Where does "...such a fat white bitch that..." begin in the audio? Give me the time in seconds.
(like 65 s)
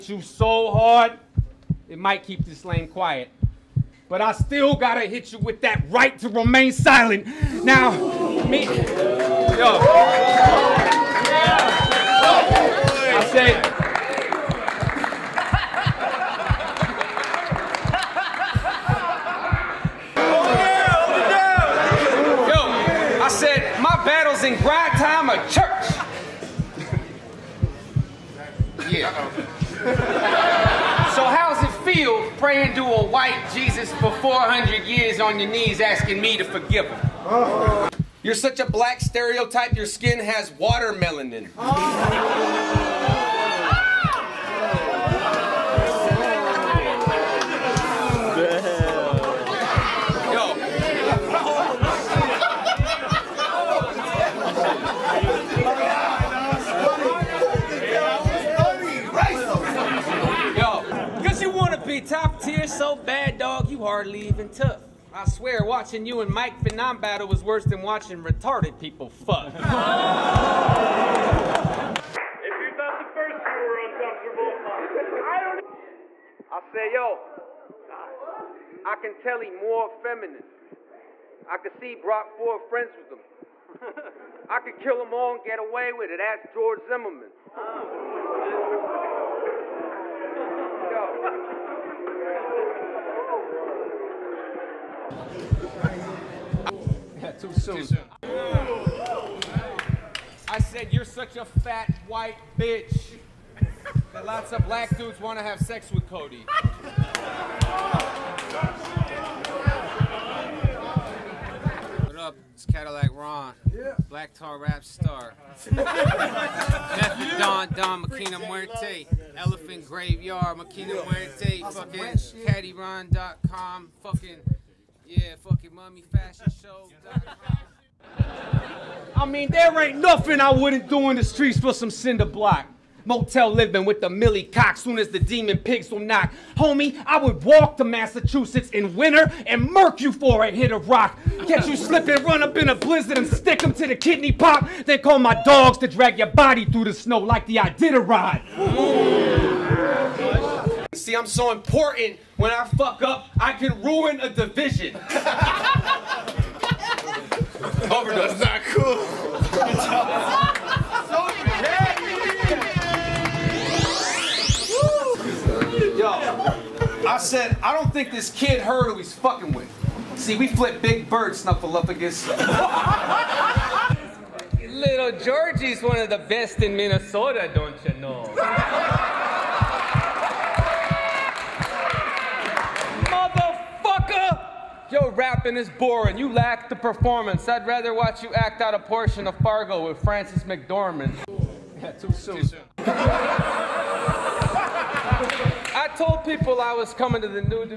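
101 s.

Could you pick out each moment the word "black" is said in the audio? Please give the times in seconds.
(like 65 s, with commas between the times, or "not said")
38 s, 104 s, 114 s.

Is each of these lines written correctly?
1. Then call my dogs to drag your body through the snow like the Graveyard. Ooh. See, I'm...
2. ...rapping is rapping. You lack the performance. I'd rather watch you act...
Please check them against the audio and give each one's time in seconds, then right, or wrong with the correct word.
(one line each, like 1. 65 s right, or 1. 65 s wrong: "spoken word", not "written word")
1. 144 s wrong: "Iditarod", not "Graveyard"
2. 185 s wrong: "boring", not "rapping".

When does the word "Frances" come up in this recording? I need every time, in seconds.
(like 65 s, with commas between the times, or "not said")
190 s.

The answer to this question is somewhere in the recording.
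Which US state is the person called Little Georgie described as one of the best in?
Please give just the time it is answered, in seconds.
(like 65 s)
176 s.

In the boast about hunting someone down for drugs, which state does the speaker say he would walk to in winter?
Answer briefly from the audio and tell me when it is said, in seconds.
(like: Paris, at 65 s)
Massachusetts, at 137 s.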